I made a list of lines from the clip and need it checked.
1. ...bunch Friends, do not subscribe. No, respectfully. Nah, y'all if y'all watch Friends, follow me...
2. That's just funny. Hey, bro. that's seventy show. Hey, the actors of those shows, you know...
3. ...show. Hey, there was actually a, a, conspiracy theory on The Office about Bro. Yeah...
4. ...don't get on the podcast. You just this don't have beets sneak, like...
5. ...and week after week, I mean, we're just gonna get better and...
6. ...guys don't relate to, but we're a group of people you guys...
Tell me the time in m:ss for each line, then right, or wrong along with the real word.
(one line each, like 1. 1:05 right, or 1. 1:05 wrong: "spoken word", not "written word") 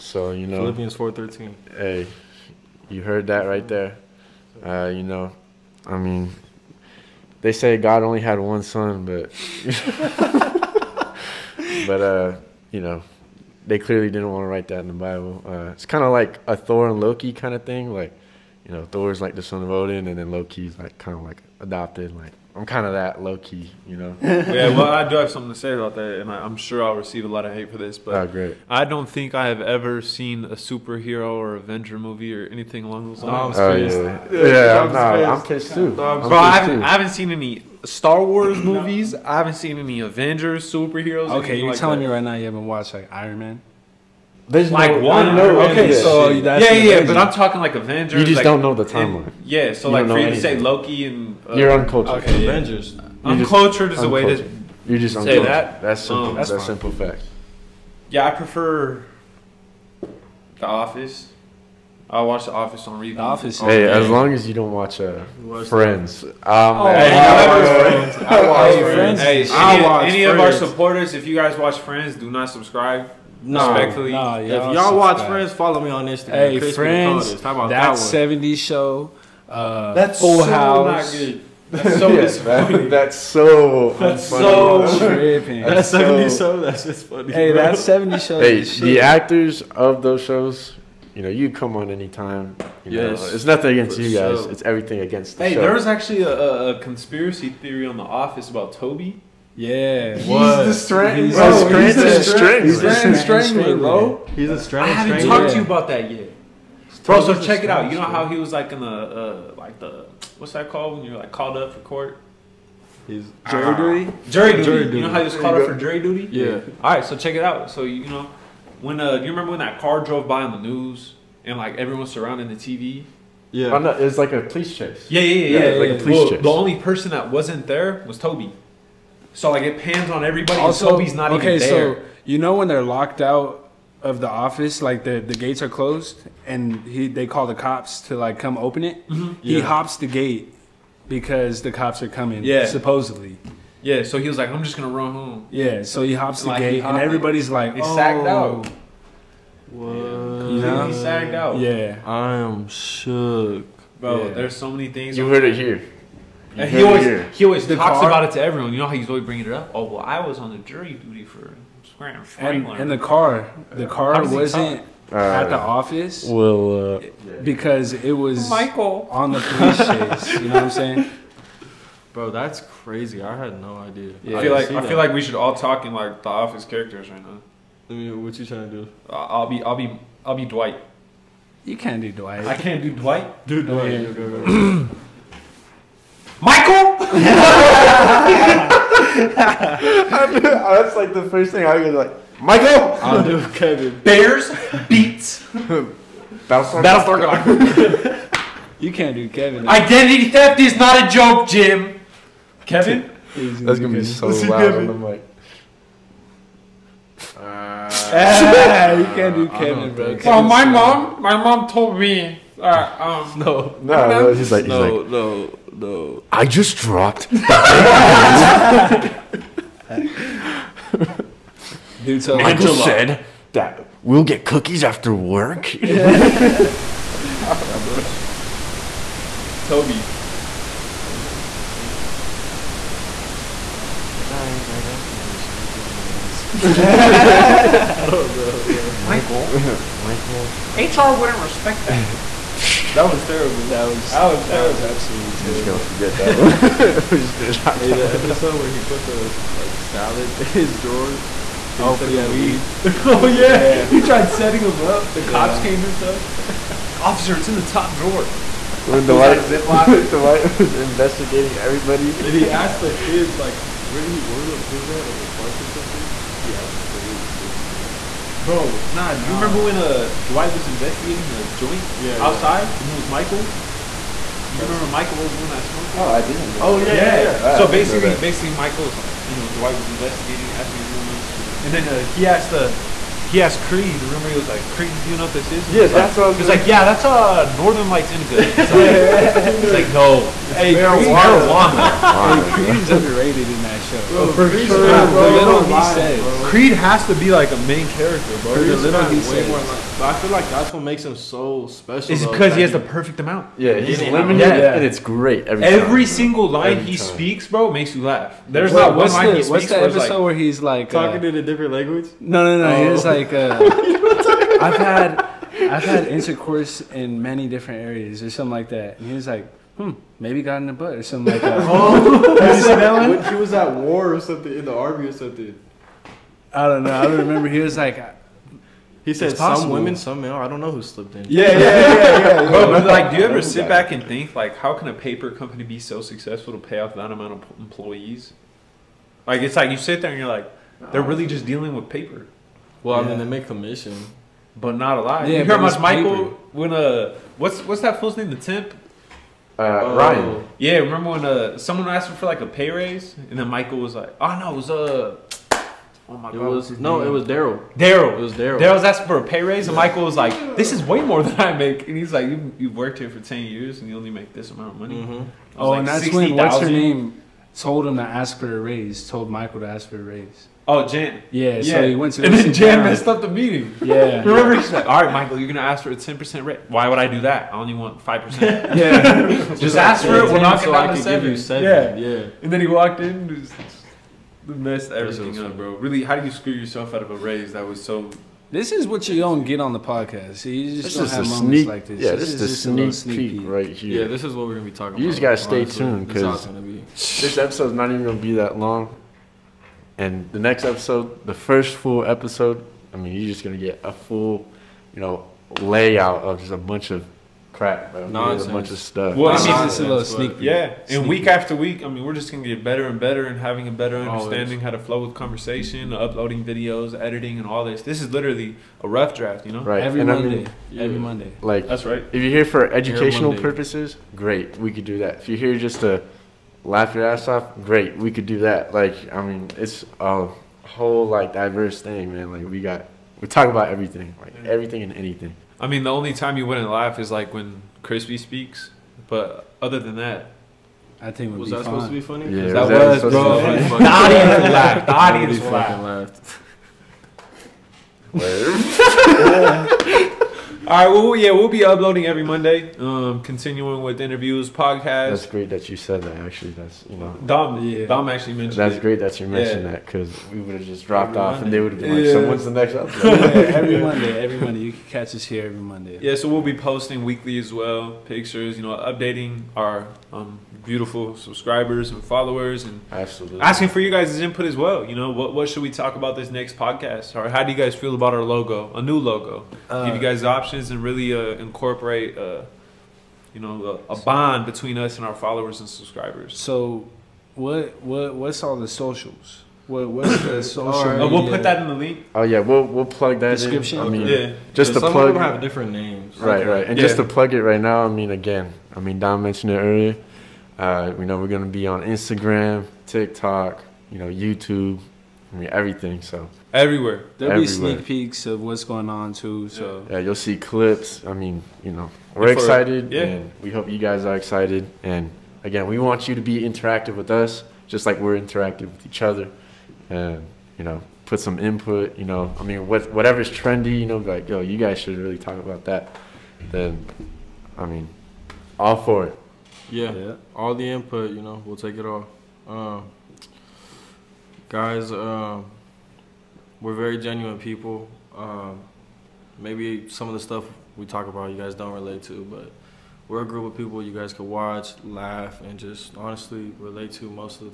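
1. 1:11 wrong: "watch", not "bunch"
2. 1:26 right
3. 1:35 wrong: "Toby", not "Bro"
4. 6:29 wrong: "moments", not "beets"
5. 6:50 right
6. 9:01 right.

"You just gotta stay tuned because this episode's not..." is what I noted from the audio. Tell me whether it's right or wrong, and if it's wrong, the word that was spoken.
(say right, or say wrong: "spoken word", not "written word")
right.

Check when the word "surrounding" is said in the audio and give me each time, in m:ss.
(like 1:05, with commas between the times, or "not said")
2:02.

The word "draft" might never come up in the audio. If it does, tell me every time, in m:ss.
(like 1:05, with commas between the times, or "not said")
6:59.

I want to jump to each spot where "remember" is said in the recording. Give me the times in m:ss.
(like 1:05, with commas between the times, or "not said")
1:59, 4:29, 4:34, 4:44, 5:27, 5:50, 6:14.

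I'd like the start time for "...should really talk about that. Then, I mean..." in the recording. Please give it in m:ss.
8:44.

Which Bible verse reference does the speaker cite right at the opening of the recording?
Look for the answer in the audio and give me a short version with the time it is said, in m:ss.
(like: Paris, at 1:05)
Philippians 4:13, at 0:00.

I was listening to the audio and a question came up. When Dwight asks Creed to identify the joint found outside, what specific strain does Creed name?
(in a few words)
Northern Lights indica.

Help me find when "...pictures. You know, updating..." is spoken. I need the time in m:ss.
7:48.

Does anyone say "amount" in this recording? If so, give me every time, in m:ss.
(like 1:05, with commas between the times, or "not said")
5:03, 5:37, 6:04.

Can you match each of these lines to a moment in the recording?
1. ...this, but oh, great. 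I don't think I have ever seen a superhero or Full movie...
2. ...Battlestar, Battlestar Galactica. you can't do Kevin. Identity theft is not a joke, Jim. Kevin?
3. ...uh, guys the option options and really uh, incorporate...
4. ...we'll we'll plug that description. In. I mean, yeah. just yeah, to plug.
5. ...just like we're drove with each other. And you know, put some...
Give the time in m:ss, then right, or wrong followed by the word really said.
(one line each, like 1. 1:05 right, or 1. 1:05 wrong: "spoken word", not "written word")
1. 0:27 wrong: "Avenger", not "Full"
2. 3:16 right
3. 7:59 right
4. 8:12 right
5. 8:37 wrong: "interactive", not "drove".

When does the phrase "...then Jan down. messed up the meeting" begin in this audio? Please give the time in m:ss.
6:12.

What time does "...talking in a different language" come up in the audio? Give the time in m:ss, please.
5:11.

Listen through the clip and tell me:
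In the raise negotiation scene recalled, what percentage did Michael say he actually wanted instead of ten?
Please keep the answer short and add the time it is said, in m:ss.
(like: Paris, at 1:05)
5%, at 6:18.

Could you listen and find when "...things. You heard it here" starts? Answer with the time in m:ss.
2:34.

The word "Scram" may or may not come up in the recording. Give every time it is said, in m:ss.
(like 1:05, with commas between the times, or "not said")
2:41.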